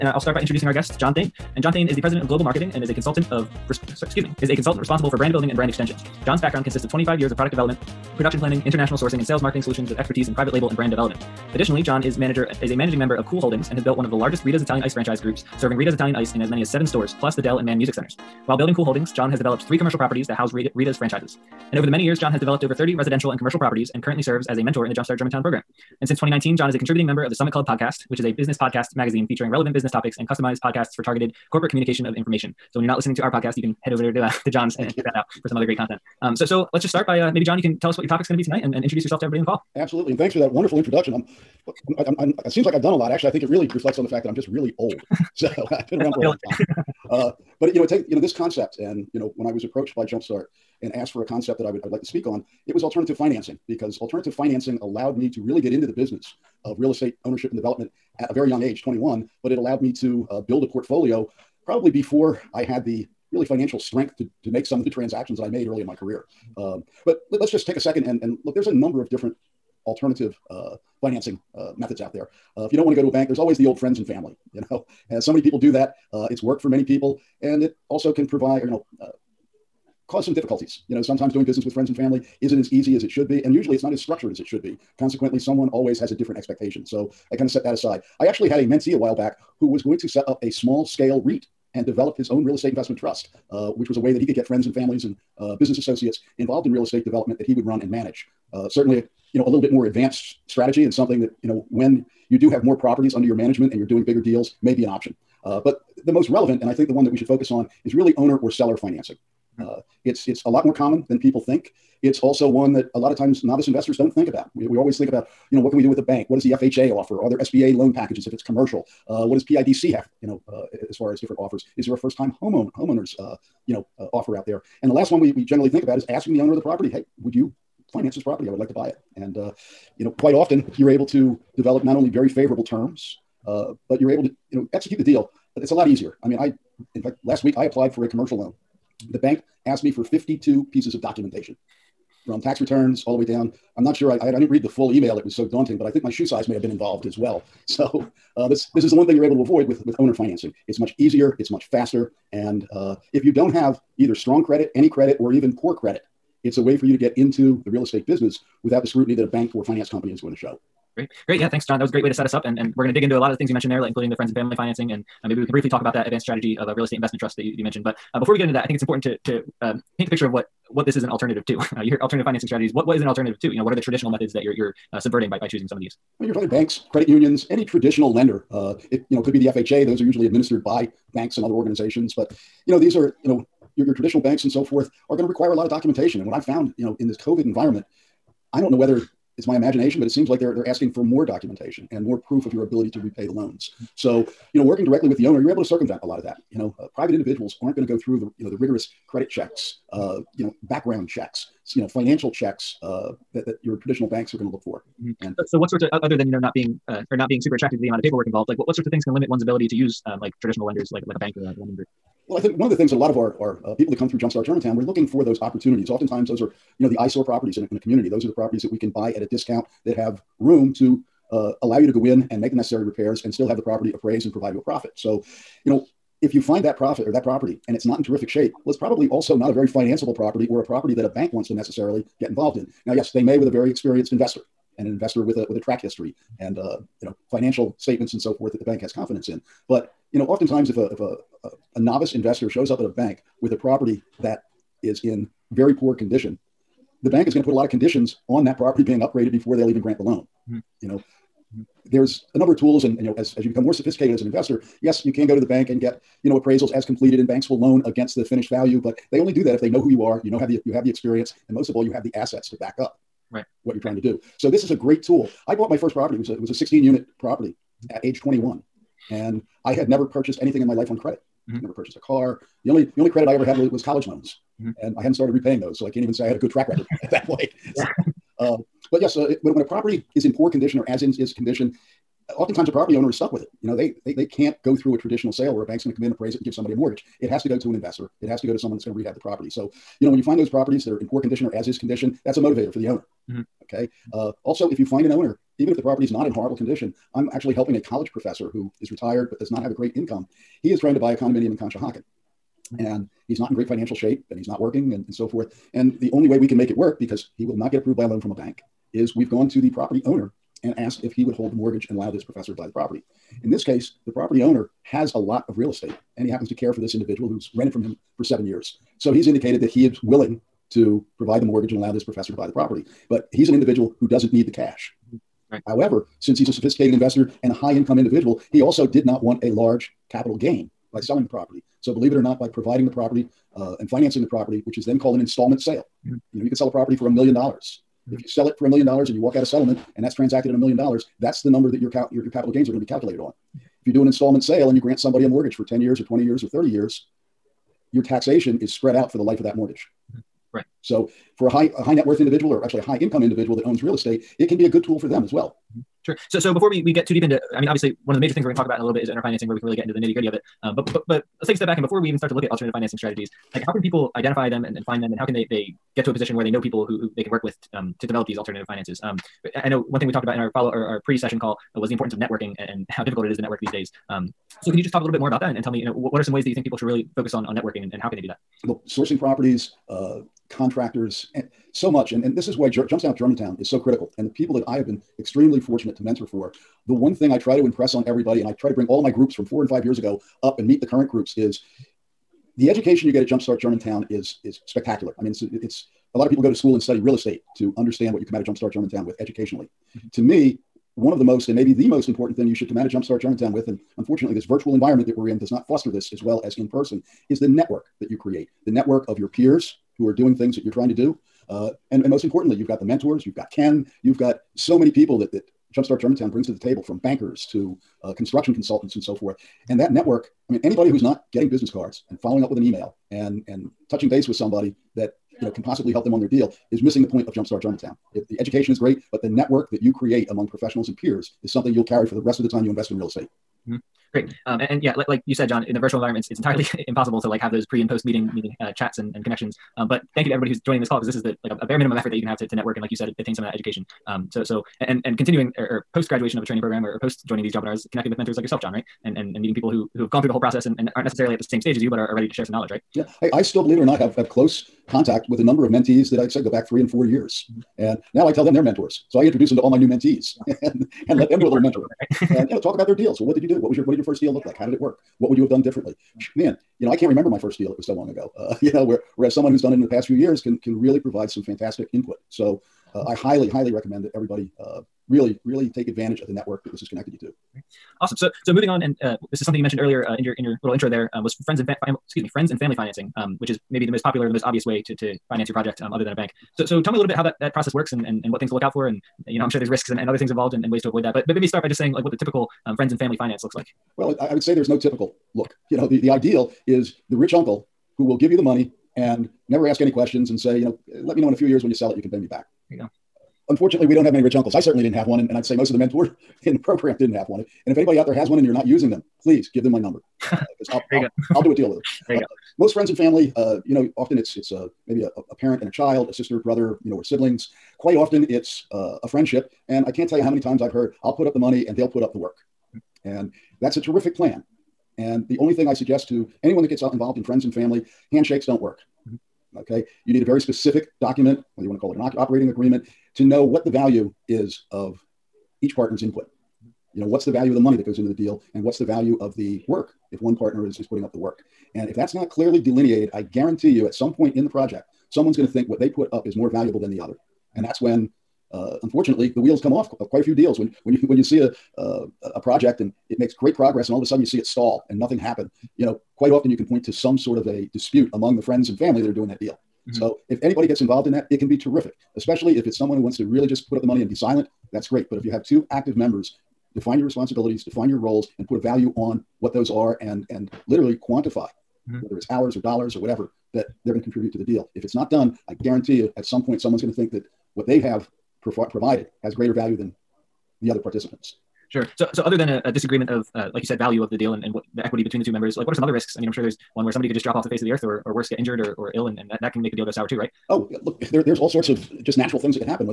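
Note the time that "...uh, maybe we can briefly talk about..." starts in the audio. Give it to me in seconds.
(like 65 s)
165 s.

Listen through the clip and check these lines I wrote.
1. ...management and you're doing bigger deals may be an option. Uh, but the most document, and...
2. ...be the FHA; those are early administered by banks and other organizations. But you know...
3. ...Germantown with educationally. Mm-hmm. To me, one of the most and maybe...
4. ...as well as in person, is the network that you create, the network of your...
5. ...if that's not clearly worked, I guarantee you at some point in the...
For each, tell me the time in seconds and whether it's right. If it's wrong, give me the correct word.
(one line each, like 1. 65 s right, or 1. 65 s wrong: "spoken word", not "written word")
1. 103 s wrong: "relevant", not "document"
2. 179 s wrong: "usually", not "early"
3. 398 s right
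4. 406 s right
5. 541 s wrong: "delineated", not "worked".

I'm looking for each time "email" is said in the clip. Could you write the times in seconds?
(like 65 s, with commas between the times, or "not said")
144 s, 422 s.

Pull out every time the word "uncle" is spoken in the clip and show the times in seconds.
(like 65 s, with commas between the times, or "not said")
497 s, 504 s.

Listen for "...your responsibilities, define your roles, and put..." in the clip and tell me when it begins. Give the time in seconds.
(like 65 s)
566 s.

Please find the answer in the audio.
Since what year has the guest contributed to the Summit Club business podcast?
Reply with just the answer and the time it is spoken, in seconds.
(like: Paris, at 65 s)
2019, at 26 s.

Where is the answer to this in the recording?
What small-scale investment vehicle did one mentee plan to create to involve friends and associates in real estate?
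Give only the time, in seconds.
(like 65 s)
91 s.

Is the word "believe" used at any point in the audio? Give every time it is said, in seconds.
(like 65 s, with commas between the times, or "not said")
331 s, 453 s.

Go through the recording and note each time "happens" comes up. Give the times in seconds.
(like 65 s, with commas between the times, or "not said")
316 s, 555 s.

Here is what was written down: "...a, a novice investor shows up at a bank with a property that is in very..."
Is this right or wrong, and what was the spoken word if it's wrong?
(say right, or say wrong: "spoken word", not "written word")
right.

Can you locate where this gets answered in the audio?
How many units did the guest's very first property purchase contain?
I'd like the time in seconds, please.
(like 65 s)
266 s.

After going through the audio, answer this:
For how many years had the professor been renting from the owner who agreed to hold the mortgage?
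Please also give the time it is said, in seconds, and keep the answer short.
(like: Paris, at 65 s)
7, at 318 s.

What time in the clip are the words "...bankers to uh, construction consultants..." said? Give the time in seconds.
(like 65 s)
416 s.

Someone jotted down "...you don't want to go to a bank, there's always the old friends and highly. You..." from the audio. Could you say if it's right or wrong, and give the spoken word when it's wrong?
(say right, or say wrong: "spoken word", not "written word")
wrong: "family", not "highly".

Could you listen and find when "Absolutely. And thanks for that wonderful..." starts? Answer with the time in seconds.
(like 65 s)
39 s.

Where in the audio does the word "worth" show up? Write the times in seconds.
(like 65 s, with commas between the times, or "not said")
352 s.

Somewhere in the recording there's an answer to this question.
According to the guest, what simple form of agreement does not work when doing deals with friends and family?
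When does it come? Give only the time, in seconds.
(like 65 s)
528 s.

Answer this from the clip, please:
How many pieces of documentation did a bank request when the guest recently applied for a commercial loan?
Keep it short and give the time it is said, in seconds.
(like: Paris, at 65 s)
52, at 140 s.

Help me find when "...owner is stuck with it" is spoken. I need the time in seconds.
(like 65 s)
282 s.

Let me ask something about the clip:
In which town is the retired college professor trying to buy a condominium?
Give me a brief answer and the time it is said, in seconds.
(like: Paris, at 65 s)
Conshohocken, at 301 s.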